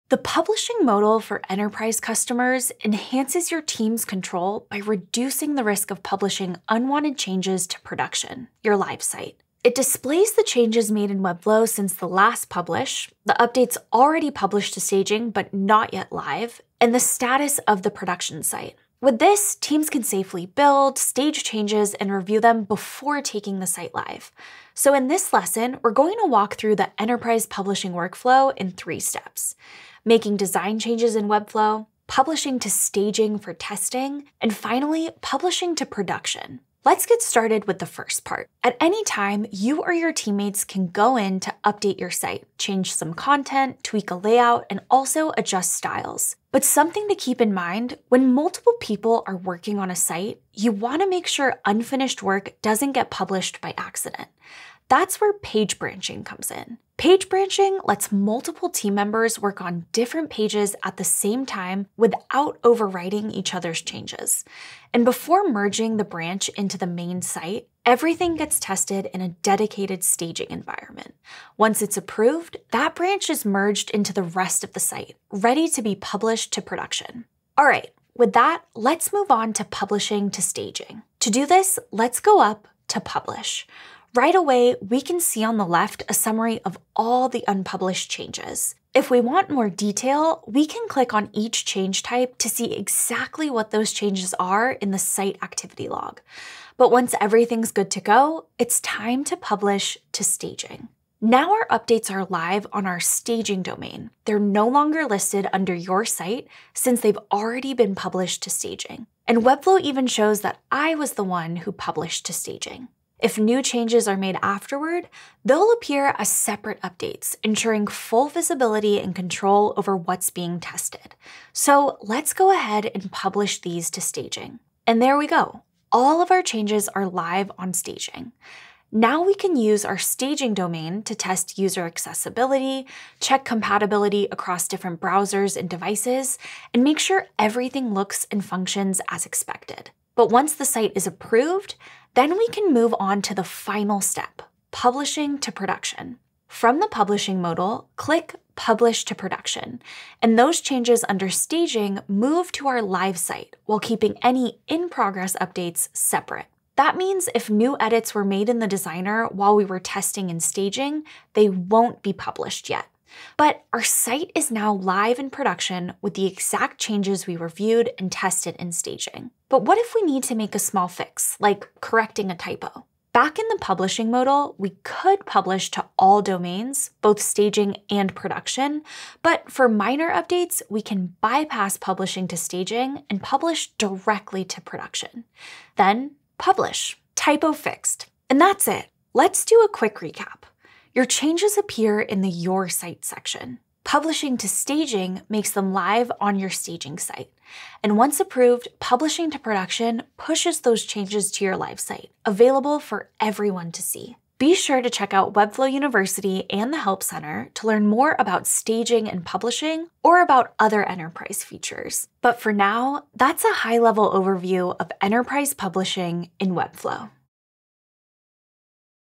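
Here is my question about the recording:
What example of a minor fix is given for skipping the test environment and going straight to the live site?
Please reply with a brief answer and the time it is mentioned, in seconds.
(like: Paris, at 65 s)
Correcting a typo, at 171 s.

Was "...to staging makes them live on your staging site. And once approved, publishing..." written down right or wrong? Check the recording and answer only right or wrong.
right.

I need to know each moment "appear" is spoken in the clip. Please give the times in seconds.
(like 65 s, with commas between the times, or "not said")
115 s, 191 s.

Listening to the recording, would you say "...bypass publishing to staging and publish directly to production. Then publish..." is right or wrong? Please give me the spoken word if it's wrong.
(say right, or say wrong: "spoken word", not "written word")
right.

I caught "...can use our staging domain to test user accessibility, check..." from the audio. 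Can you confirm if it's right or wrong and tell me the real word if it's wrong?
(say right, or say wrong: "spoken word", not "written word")
right.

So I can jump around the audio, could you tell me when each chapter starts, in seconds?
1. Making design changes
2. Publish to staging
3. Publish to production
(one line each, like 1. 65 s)
1. 36 s
2. 78 s
3. 142 s.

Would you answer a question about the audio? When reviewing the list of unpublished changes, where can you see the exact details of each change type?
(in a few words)
Site activity log.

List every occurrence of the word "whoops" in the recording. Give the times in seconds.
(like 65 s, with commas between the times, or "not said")
not said.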